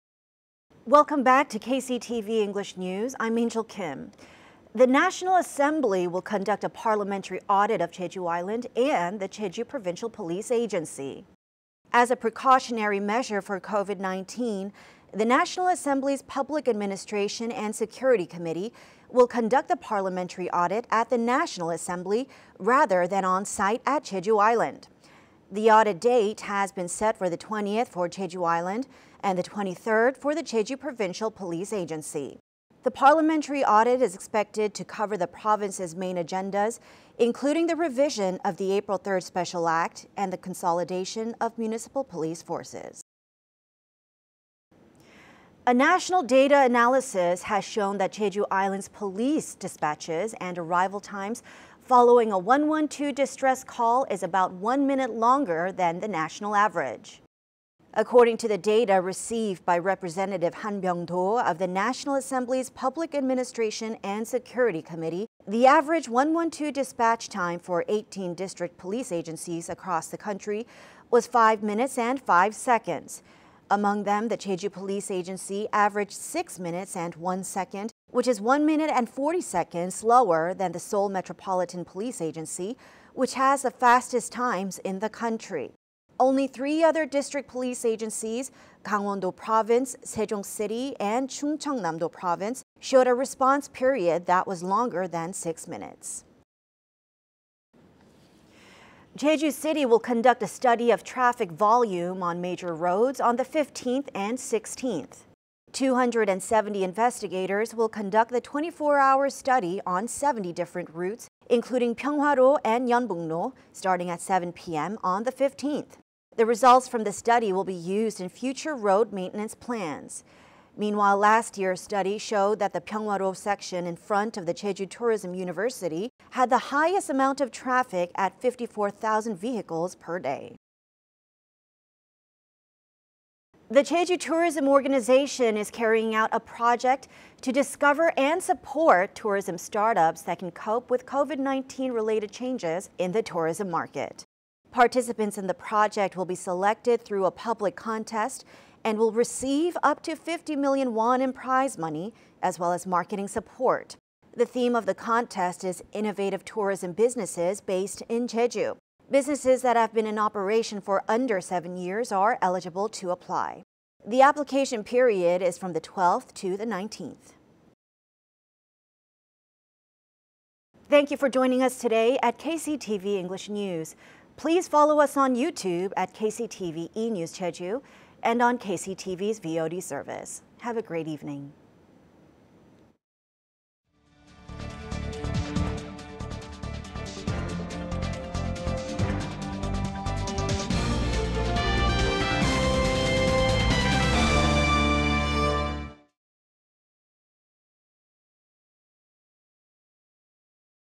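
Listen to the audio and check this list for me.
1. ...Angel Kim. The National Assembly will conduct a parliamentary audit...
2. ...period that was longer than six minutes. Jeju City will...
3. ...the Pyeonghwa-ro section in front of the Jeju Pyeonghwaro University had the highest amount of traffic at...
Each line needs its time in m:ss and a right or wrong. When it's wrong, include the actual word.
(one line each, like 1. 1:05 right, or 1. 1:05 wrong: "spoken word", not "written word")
1. 0:03 right
2. 1:33 right
3. 2:02 wrong: "Tourism", not "Pyeonghwaro".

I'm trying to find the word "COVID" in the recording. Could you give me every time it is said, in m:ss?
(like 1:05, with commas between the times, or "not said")
0:13, 2:21.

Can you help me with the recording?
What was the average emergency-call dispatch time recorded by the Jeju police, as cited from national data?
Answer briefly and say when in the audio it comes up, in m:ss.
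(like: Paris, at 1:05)
6 minutes and 1 second, at 1:16.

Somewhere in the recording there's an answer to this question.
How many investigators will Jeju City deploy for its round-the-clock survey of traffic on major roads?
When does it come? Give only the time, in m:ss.
1:45.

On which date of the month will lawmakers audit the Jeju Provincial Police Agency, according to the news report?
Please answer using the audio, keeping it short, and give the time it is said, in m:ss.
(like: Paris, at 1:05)
23rd, at 0:29.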